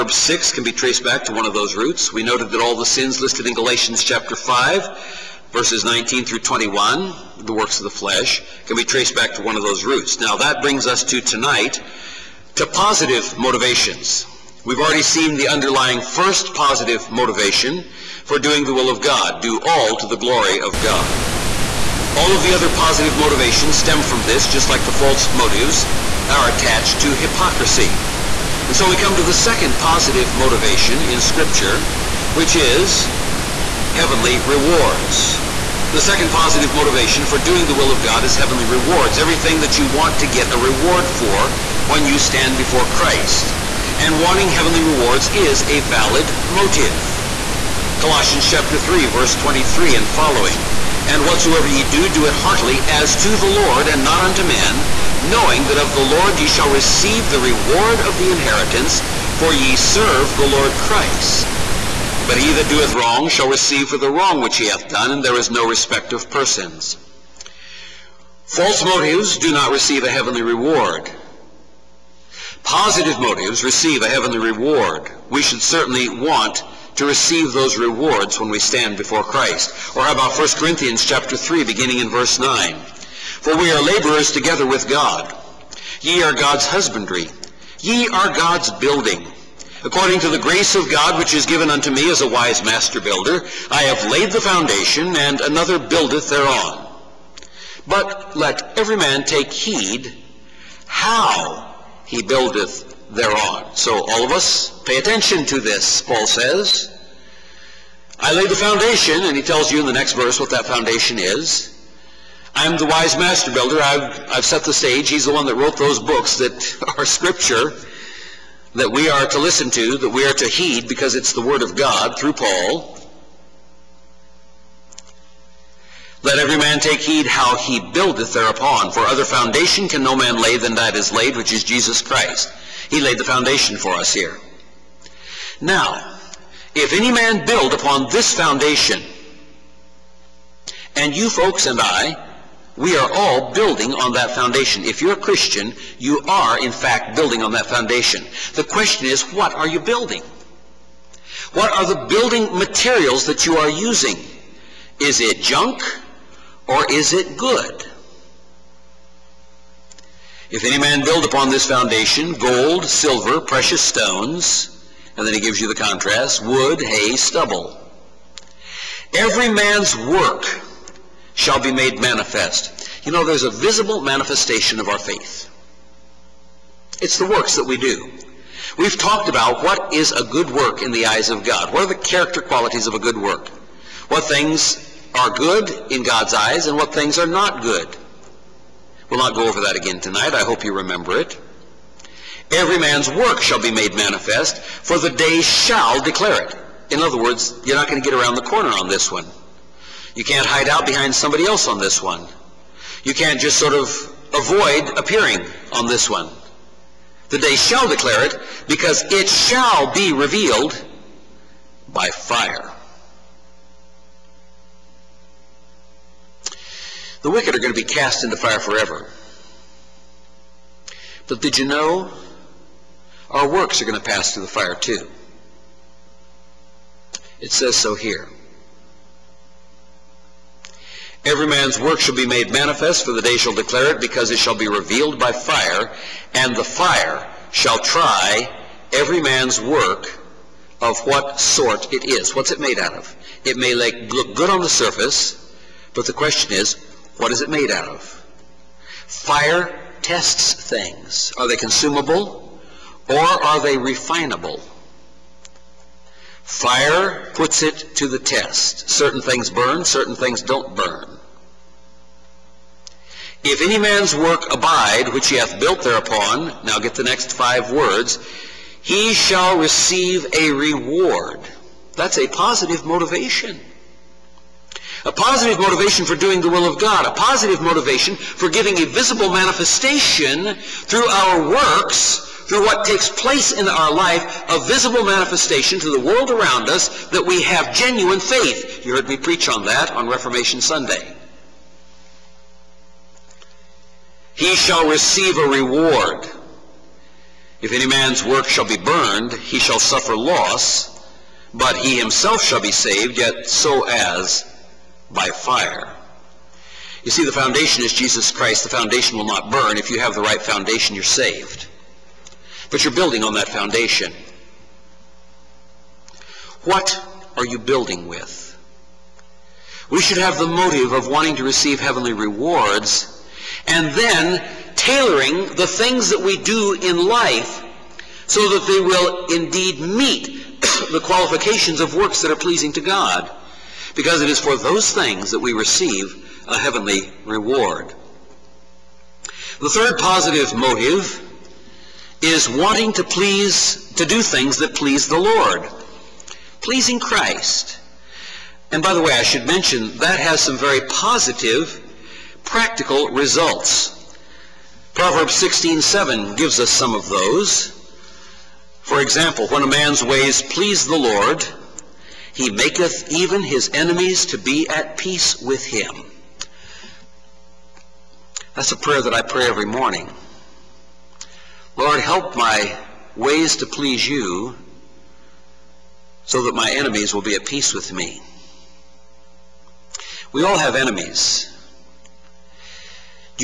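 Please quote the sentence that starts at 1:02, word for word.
But he that doeth wrong shall receive for the wrong which he hath done, and there is no respect of persons.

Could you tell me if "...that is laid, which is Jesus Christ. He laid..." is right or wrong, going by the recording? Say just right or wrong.
right.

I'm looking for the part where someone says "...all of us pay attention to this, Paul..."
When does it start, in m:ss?
1:44.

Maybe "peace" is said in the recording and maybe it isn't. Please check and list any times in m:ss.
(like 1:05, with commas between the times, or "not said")
6:04, 6:17.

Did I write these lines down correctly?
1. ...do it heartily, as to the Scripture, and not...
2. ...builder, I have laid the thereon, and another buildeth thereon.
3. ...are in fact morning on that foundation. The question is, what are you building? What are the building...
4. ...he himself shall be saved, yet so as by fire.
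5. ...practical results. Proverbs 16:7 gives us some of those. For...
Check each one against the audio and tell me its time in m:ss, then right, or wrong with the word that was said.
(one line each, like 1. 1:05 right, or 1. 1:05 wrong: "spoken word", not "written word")
1. 0:52 wrong: "Lord", not "Scripture"
2. 1:33 wrong: "foundation", not "thereon"
3. 2:26 wrong: "building", not "morning"
4. 5:01 right
5. 5:52 right.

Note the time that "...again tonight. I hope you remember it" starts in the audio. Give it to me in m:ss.
3:09.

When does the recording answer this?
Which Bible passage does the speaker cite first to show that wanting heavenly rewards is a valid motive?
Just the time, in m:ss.
0:47.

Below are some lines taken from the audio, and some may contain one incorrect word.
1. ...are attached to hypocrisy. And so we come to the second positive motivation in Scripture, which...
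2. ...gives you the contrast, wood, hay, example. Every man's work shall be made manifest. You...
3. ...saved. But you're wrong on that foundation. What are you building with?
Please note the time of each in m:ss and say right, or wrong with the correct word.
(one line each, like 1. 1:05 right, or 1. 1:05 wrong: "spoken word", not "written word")
1. 0:26 right
2. 2:45 wrong: "stubble", not "example"
3. 5:11 wrong: "building", not "wrong".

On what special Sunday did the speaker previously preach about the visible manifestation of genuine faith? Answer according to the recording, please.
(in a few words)
Reformation Sunday.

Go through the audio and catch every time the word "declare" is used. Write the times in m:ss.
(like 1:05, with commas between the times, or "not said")
3:16, 3:27, 3:53.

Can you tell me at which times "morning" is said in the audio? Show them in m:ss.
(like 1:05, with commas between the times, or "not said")
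6:09.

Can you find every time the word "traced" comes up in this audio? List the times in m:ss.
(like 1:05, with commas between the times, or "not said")
0:00, 0:08.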